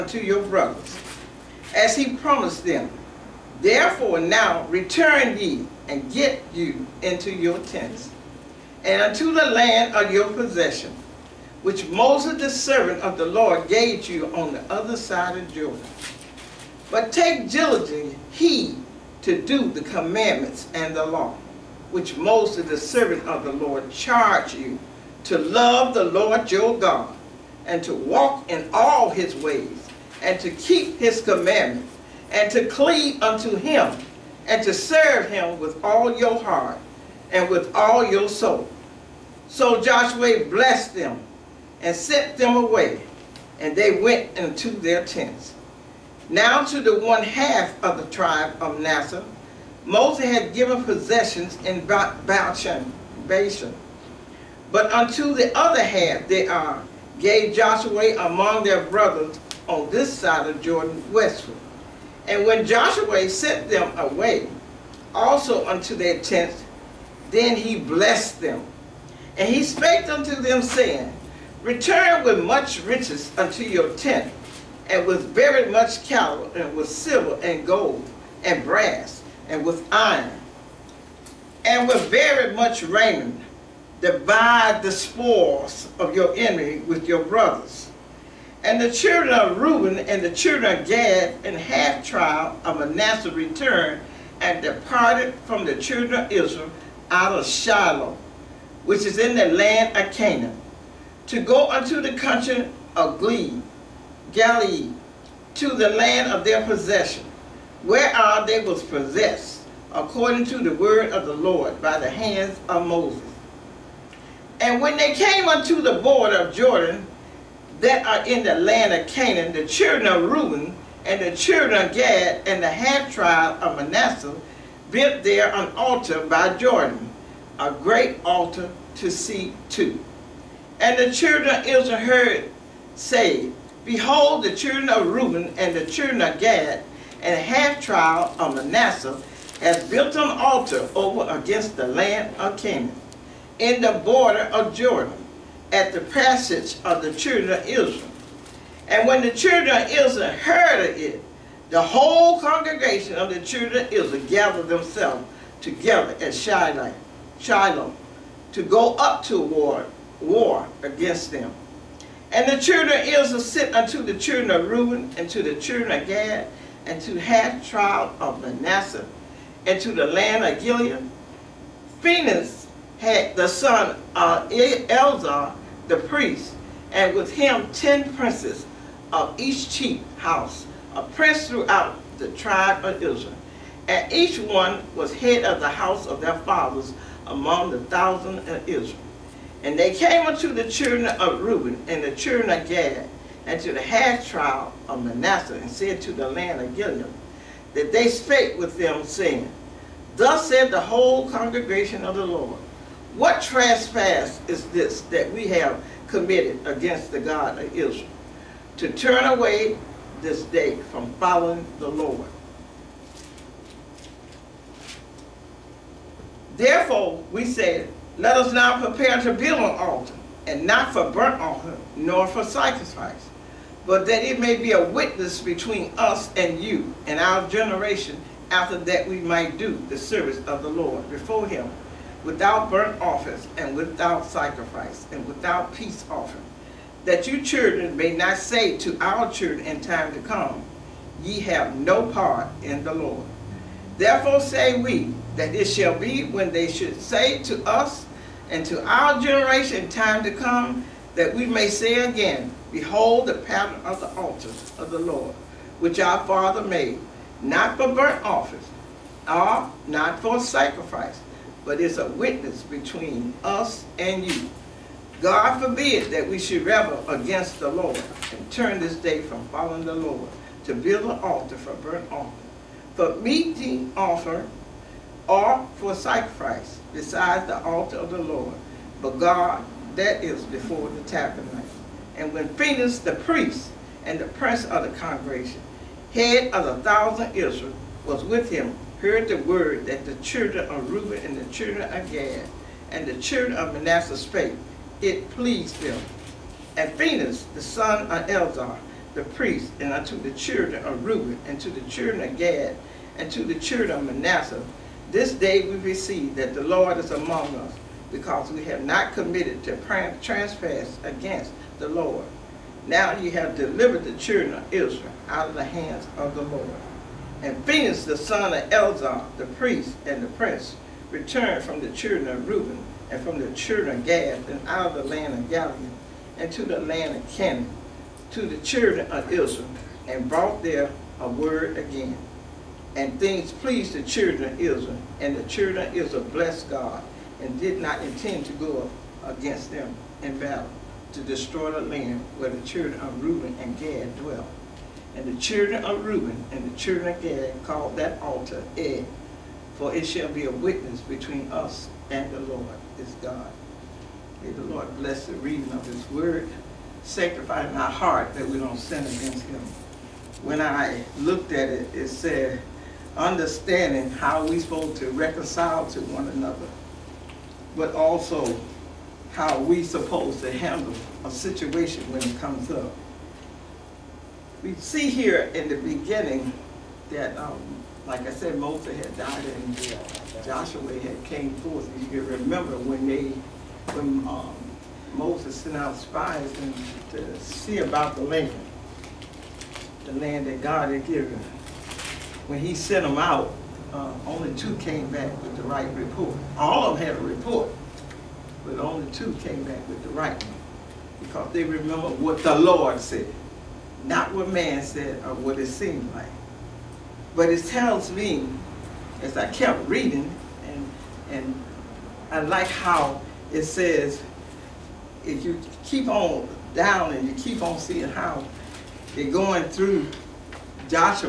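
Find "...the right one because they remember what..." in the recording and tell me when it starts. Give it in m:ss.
6:40.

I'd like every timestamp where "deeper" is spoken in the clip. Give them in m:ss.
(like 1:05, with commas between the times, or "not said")
not said.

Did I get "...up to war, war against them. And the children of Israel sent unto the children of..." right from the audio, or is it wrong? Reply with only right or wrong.
right.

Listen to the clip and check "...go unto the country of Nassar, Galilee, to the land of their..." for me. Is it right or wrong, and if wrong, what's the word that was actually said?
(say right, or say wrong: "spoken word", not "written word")
wrong: "Gilead", not "Nassar".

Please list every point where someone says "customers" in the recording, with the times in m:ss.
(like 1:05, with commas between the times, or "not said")
not said.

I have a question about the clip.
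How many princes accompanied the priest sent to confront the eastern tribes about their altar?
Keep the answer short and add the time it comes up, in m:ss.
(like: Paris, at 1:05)
10, at 2:57.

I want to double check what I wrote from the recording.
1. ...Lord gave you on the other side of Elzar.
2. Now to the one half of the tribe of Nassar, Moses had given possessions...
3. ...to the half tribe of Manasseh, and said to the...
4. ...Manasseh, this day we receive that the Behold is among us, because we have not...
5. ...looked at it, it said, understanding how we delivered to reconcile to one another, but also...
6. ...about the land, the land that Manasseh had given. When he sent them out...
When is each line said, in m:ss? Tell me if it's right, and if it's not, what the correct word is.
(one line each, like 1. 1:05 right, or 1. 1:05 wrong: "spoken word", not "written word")
1. 0:13 wrong: "Jordan", not "Elzar"
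2. 0:46 right
3. 3:13 right
4. 5:04 wrong: "Lord", not "Behold"
5. 6:01 wrong: "supposed", not "delivered"
6. 6:27 wrong: "God", not "Manasseh".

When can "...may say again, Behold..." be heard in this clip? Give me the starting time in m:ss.
4:11.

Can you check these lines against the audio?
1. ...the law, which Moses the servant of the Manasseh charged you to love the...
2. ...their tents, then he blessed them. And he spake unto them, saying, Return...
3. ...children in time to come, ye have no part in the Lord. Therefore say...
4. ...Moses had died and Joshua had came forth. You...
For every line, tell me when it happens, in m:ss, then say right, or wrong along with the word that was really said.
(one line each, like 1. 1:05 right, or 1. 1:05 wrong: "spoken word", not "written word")
1. 0:20 wrong: "Lord", not "Manasseh"
2. 1:05 right
3. 3:59 right
4. 6:18 right.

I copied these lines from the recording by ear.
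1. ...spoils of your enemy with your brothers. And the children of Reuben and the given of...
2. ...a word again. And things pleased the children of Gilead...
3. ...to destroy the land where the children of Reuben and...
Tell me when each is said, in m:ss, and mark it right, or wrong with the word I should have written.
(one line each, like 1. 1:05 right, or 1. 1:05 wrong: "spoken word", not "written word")
1. 1:24 wrong: "children", not "given"
2. 5:31 wrong: "Israel", not "Gilead"
3. 5:41 right.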